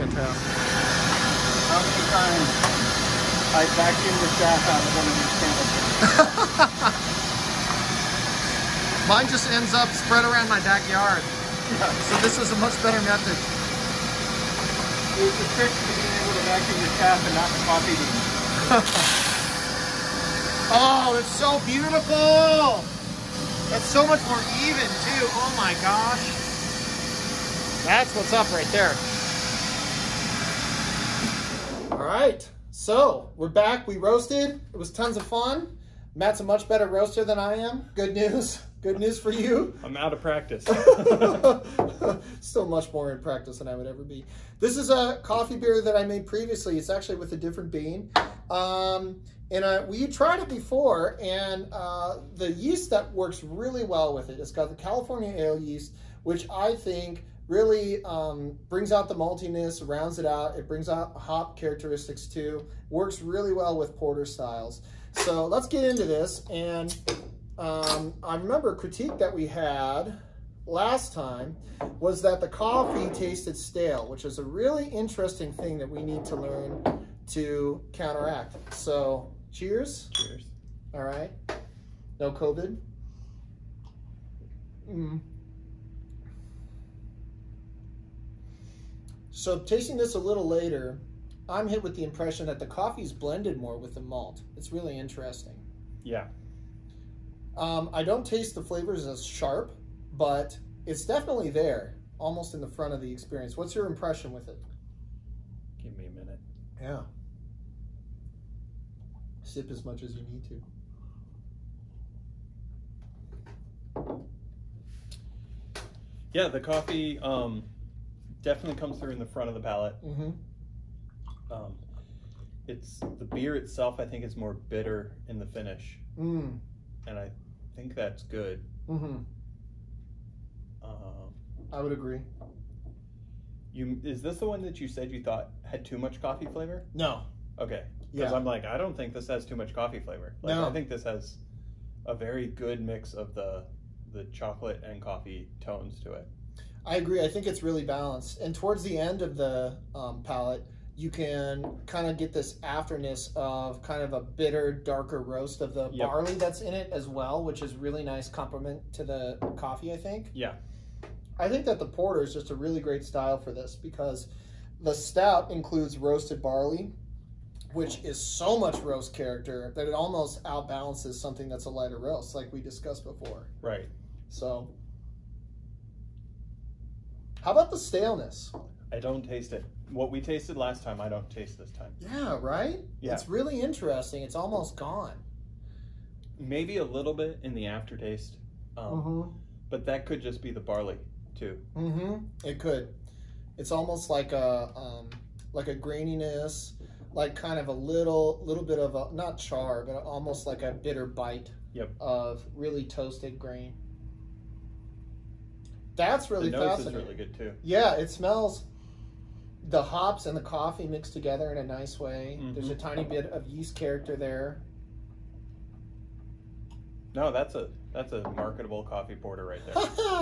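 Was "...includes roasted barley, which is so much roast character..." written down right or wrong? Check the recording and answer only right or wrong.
right.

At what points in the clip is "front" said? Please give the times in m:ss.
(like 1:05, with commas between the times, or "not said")
1:42, 1:59.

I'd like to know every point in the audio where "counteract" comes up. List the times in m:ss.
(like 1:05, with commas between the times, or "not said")
1:17.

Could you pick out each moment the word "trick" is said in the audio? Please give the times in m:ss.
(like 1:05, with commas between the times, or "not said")
0:15.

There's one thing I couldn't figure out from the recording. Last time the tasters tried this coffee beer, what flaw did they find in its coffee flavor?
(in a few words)
Stale.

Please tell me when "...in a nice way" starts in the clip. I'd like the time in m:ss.
3:31.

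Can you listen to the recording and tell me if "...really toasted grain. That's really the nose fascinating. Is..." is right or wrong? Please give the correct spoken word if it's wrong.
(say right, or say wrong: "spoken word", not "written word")
right.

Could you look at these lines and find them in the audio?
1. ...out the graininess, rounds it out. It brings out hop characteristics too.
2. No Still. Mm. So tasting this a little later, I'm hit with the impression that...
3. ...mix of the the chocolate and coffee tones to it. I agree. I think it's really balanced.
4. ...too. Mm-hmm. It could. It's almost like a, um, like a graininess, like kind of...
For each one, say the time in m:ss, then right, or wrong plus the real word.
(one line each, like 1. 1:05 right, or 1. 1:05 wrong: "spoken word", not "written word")
1. 0:58 wrong: "maltiness", not "graininess"
2. 1:22 wrong: "COVID", not "Still"
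3. 2:22 right
4. 3:11 right.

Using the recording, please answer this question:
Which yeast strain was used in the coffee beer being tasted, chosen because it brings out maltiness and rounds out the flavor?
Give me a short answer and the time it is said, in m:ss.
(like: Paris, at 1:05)
California ale yeast, at 0:54.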